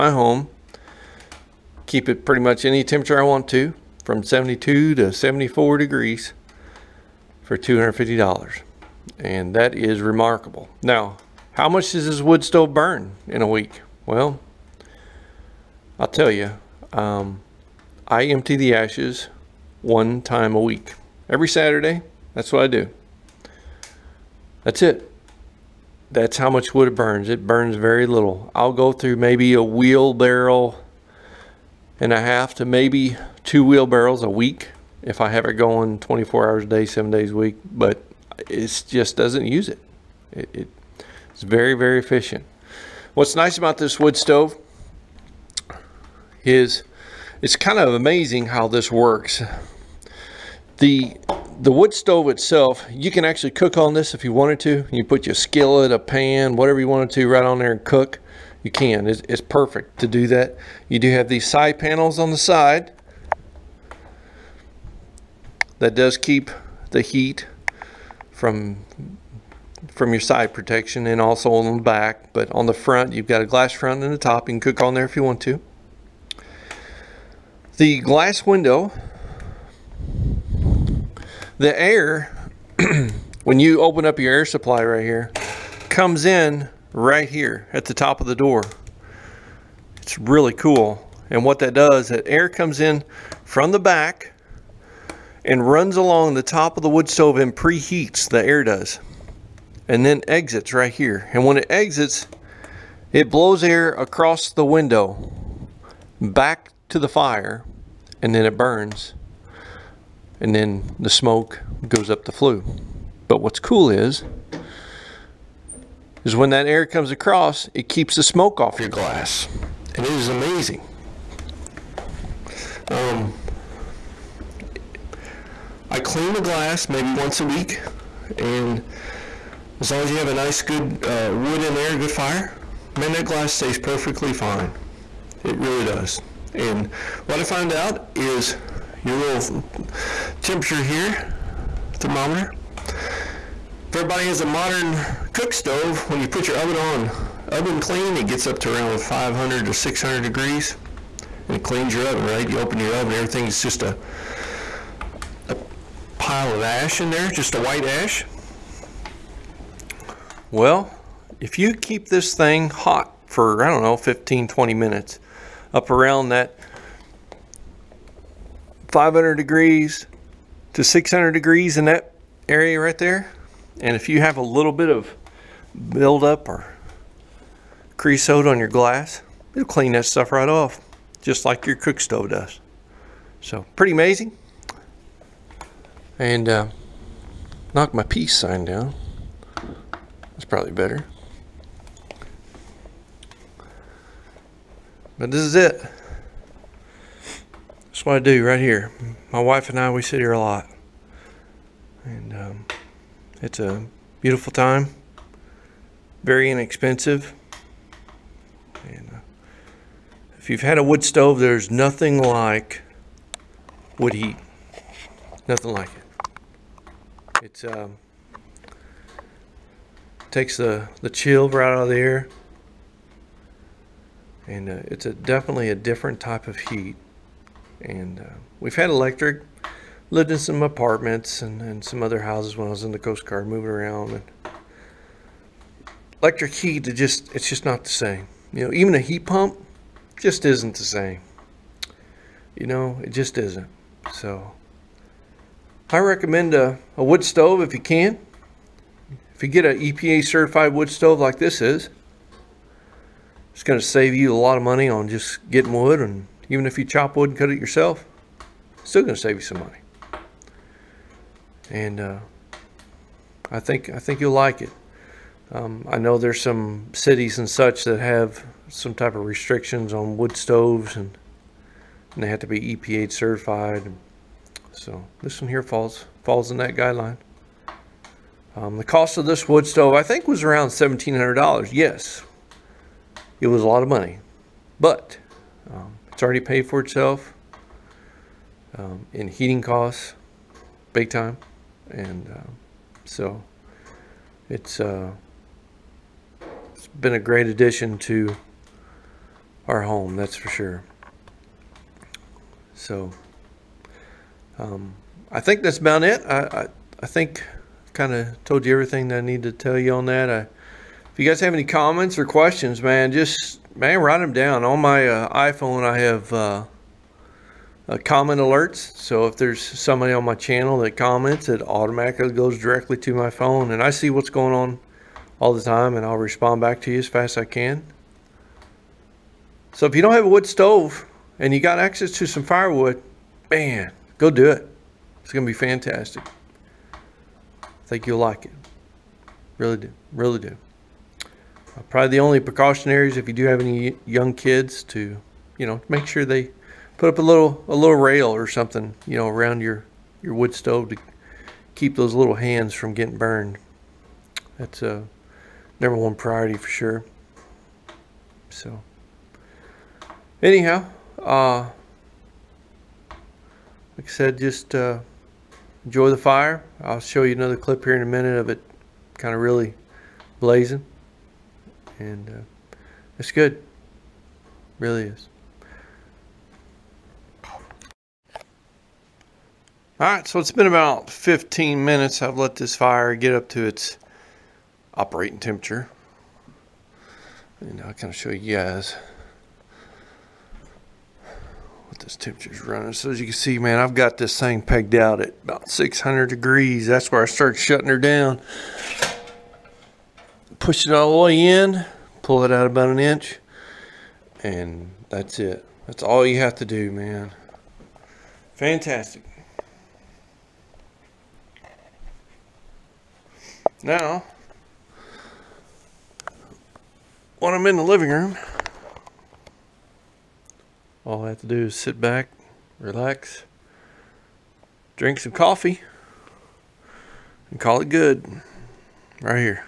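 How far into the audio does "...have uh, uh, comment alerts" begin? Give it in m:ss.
5:15.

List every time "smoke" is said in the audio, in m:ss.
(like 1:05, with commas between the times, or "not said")
1:51, 1:58.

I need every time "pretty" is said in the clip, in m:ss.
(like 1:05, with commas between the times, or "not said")
0:02, 3:03.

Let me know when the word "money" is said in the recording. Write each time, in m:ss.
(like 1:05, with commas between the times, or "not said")
4:14, 4:19, 4:43.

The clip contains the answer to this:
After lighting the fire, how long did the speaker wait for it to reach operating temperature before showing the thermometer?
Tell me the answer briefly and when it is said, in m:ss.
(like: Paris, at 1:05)
15 minutes, at 6:21.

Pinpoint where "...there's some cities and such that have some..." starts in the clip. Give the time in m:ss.
4:26.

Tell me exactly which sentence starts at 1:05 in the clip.
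That does keep the heat from from your side protection and also on the back.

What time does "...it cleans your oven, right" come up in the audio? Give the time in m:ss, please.
2:31.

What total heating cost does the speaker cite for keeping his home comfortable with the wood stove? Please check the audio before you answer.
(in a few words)
$250.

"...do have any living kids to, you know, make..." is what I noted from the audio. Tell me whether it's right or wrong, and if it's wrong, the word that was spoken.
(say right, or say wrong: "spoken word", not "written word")
wrong: "young", not "living".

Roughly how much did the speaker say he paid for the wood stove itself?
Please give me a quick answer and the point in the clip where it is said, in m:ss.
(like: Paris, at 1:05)
$1,700, at 4:40.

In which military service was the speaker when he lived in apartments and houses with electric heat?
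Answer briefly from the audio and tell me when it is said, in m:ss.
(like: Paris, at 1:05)
Coast Guard, at 3:52.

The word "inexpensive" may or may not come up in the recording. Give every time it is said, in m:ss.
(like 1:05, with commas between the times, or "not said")
3:26.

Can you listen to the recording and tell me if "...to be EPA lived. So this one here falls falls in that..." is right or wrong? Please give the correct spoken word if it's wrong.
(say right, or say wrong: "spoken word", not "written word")
wrong: "certified", not "lived".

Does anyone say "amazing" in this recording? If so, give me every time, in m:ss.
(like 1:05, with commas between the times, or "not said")
0:47, 2:00, 3:03.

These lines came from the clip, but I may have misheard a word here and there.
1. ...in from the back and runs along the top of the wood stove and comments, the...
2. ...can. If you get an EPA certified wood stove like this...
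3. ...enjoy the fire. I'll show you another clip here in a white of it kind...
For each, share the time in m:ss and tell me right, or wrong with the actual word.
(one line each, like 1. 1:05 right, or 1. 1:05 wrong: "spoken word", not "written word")
1. 1:32 wrong: "preheats", not "comments"
2. 4:07 right
3. 6:05 wrong: "minute", not "white".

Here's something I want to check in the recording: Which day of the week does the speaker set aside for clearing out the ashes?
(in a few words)
Saturday.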